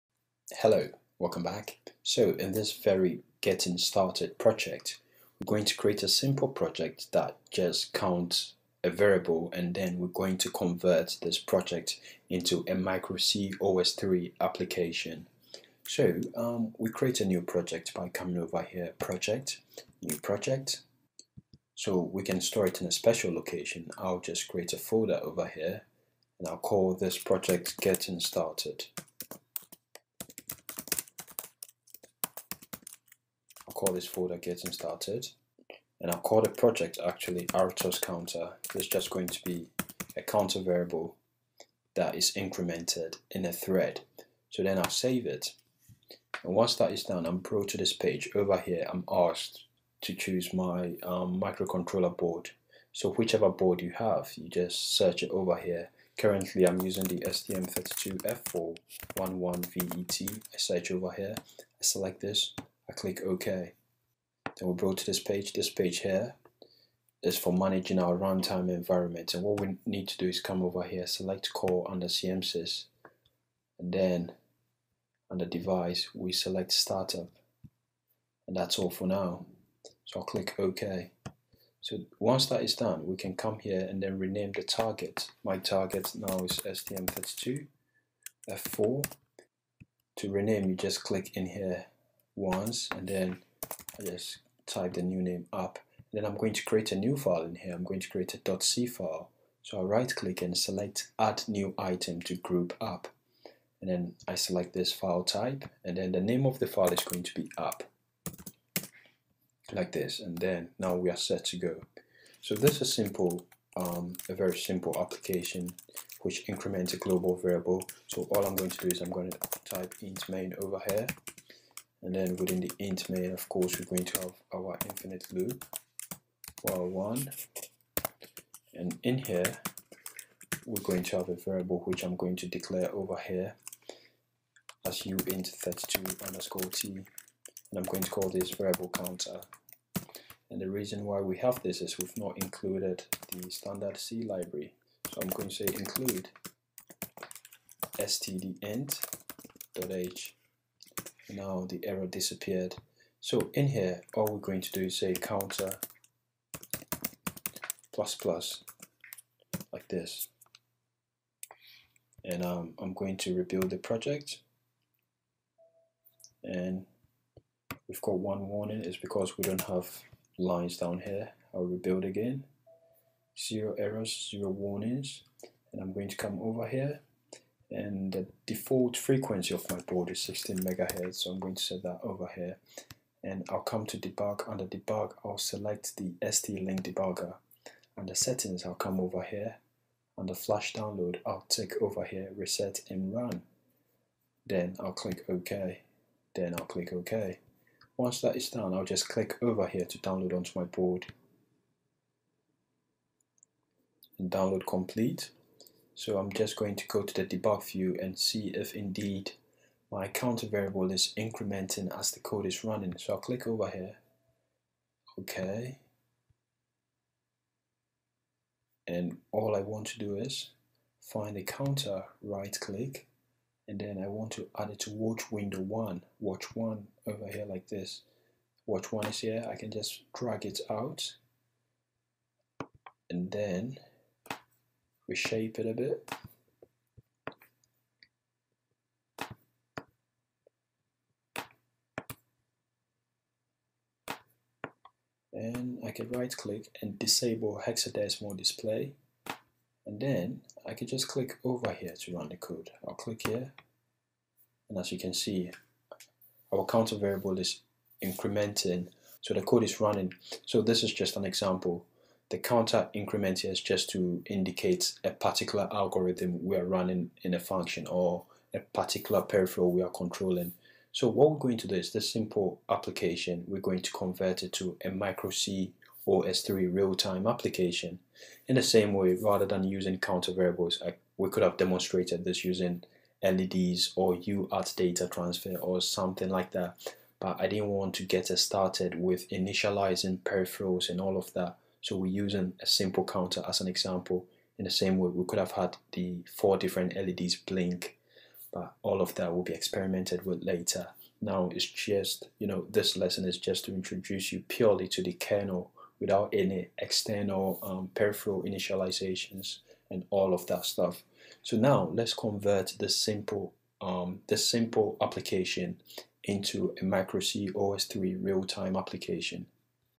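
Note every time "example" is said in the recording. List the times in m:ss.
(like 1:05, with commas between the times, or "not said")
4:21, 4:53.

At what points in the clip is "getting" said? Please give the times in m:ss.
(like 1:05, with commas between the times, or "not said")
0:03, 0:27, 0:34.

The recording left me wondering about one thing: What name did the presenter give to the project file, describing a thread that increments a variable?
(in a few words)
RTOS counter.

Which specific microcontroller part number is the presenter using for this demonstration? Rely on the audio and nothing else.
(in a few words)
STM32F411VET.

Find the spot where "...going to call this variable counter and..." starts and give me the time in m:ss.
2:17.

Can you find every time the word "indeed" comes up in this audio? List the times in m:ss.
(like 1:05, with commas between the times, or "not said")
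3:28.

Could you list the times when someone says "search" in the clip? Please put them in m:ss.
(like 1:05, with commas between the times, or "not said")
0:54, 1:00.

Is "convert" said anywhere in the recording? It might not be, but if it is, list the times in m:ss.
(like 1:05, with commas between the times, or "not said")
0:10, 4:33, 5:12.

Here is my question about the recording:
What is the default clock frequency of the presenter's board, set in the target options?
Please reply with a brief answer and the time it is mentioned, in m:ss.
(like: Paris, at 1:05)
16 megahertz, at 3:00.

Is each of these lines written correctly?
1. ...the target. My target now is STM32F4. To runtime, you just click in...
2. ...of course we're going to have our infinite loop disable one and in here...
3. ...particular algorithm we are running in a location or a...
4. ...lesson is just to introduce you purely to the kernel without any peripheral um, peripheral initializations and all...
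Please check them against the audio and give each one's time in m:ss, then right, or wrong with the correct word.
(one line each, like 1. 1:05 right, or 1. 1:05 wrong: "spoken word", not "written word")
1. 1:24 wrong: "rename", not "runtime"
2. 2:03 wrong: "while", not "disable"
3. 4:25 wrong: "function", not "location"
4. 5:02 wrong: "external", not "peripheral".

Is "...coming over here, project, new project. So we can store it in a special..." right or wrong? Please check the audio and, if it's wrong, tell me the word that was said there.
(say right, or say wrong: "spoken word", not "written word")
right.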